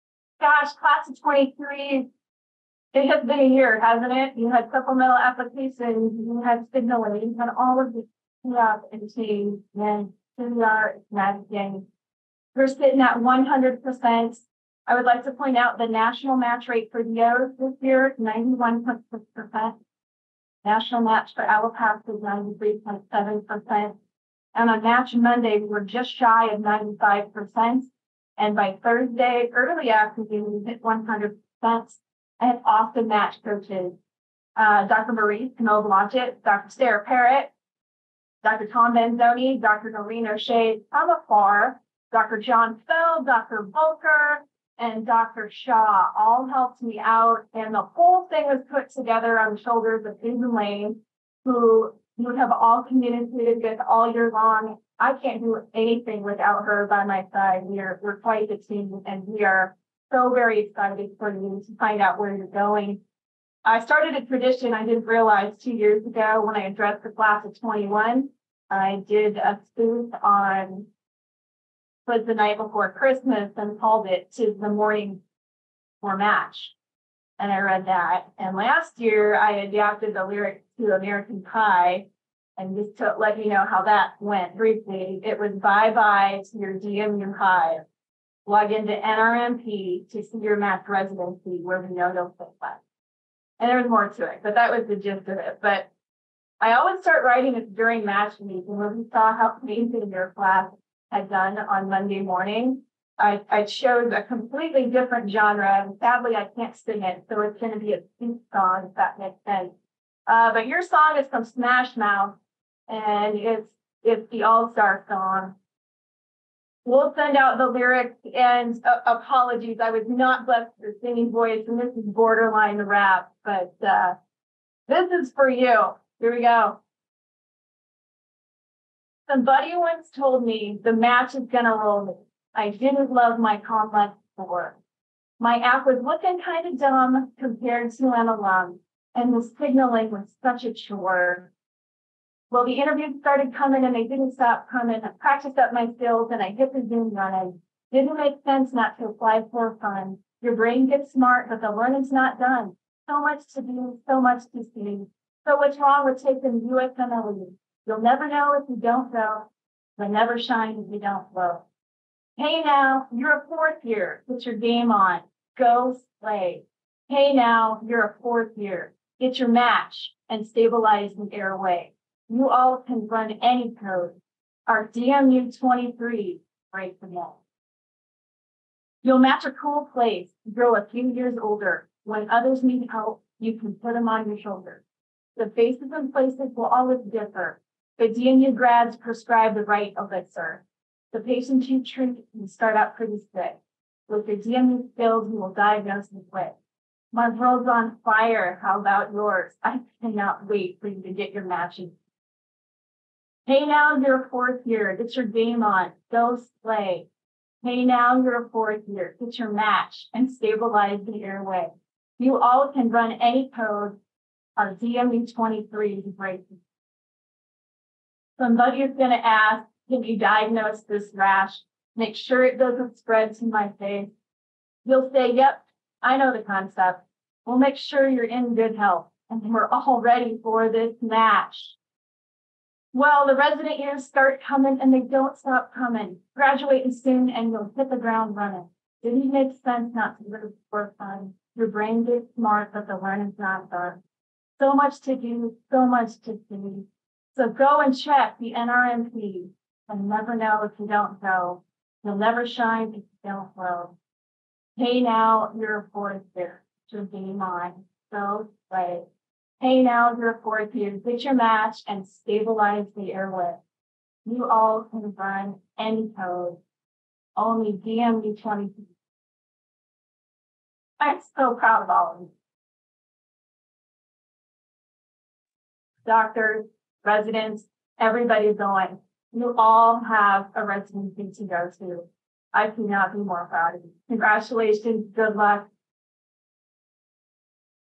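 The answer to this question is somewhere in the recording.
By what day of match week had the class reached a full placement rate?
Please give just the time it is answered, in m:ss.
0:28.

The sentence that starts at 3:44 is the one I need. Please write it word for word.
You'll say, yep, I know the concept.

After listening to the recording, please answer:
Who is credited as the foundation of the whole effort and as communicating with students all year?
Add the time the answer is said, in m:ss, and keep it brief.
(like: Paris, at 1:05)
Susan Lane, at 0:50.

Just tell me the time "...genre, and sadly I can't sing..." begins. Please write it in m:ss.
1:45.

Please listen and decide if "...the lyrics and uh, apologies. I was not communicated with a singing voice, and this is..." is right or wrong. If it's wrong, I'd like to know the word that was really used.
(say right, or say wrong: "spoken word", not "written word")
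wrong: "blessed", not "communicated".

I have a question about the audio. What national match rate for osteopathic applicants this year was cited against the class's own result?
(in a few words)
91.6%.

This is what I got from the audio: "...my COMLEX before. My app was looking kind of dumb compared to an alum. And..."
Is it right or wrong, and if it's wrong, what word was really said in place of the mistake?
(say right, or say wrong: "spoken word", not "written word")
right.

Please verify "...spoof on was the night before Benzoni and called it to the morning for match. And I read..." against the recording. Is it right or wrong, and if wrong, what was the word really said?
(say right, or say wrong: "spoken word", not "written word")
wrong: "Christmas", not "Benzoni".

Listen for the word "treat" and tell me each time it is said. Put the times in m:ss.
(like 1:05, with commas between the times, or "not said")
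3:11.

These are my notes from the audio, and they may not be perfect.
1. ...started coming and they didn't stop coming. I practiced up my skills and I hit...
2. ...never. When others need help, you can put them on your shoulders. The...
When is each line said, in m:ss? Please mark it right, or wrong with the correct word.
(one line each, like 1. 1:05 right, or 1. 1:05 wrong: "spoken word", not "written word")
1. 2:23 right
2. 3:01 wrong: "older", not "never".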